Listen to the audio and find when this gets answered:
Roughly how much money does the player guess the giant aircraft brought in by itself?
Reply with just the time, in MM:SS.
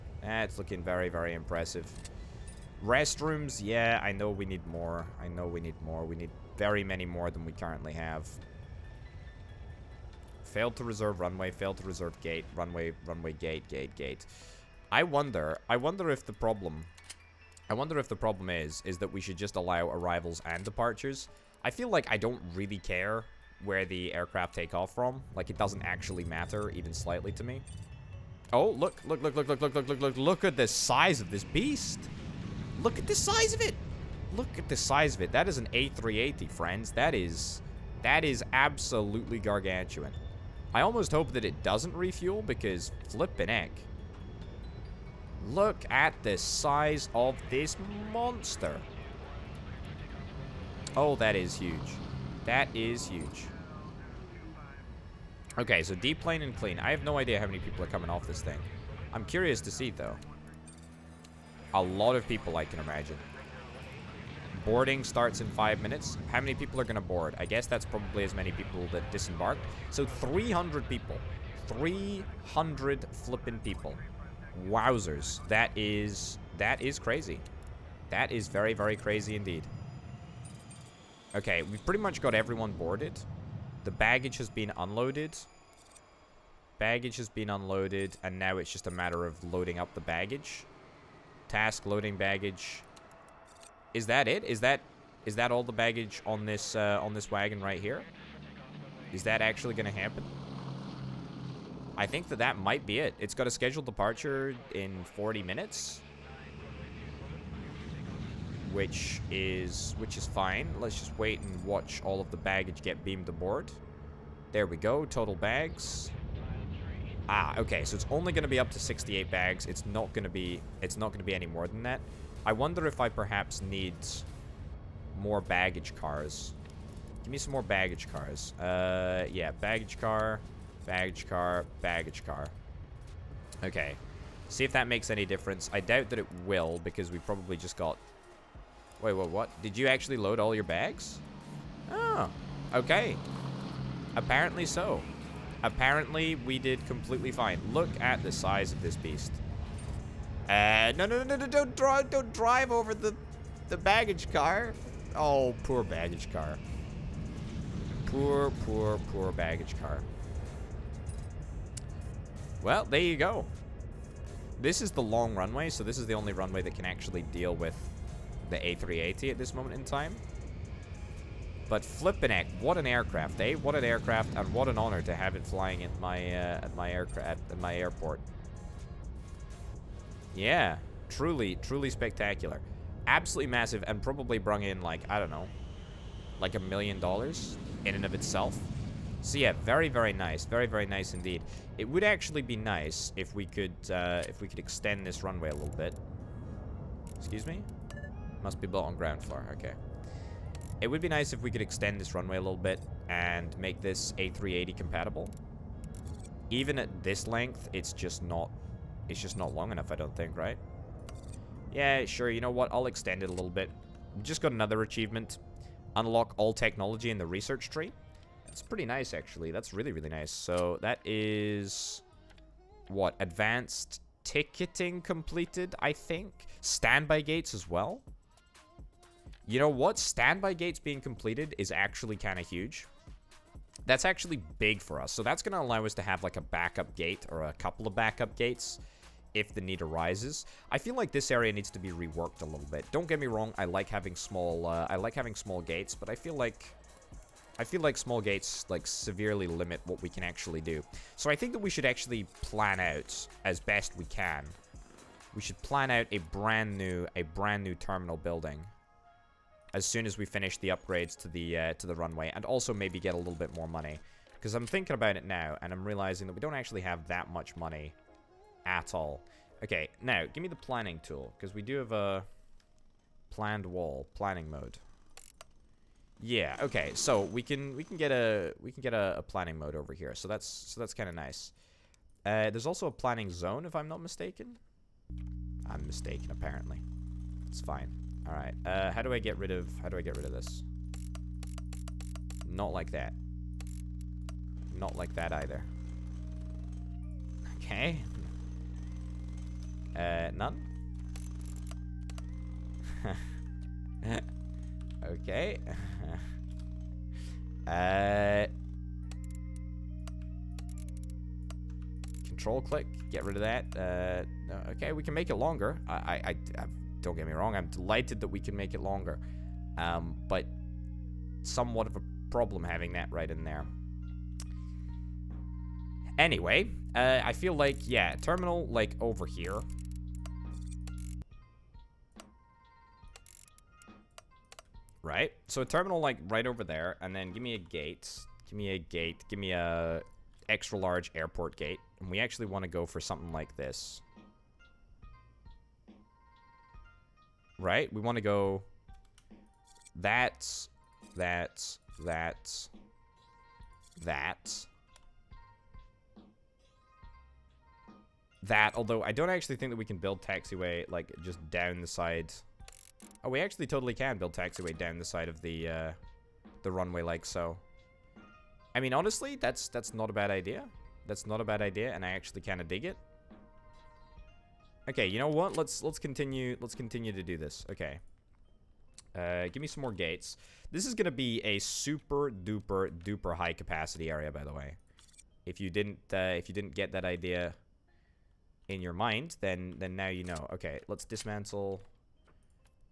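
03:06.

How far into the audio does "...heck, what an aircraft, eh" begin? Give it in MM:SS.
02:52.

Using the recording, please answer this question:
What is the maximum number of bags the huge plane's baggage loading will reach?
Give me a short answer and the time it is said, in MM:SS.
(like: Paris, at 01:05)
68, at 01:58.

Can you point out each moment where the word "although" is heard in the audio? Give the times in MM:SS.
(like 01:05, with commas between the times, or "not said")
05:58.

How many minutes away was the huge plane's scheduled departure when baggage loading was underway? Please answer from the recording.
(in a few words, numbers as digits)
40.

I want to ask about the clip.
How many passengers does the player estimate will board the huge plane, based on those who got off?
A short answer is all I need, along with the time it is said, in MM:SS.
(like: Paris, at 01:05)
300, at 01:10.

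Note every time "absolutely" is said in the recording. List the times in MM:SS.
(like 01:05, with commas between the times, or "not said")
00:38, 03:03.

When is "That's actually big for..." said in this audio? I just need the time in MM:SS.
03:53.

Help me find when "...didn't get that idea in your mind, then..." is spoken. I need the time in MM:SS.
06:26.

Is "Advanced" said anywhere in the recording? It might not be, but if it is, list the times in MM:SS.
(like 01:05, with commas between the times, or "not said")
03:43.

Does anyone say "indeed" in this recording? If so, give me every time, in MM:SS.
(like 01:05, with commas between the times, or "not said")
01:19, 03:11.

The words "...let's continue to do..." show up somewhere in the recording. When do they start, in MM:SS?
06:16.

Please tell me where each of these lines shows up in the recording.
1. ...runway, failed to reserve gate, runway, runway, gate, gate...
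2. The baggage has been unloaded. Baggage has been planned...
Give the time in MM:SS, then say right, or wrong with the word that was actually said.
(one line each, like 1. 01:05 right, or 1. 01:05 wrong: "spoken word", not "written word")
1. 00:11 right
2. 01:23 wrong: "unloaded", not "planned".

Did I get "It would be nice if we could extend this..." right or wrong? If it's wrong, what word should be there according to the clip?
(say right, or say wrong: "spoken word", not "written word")
right.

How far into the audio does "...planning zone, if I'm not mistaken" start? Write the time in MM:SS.
04:42.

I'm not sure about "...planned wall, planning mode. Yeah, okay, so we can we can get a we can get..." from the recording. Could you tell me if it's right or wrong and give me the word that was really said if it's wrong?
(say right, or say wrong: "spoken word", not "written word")
right.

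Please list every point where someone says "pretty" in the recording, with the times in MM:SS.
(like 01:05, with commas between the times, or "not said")
01:21, 03:38.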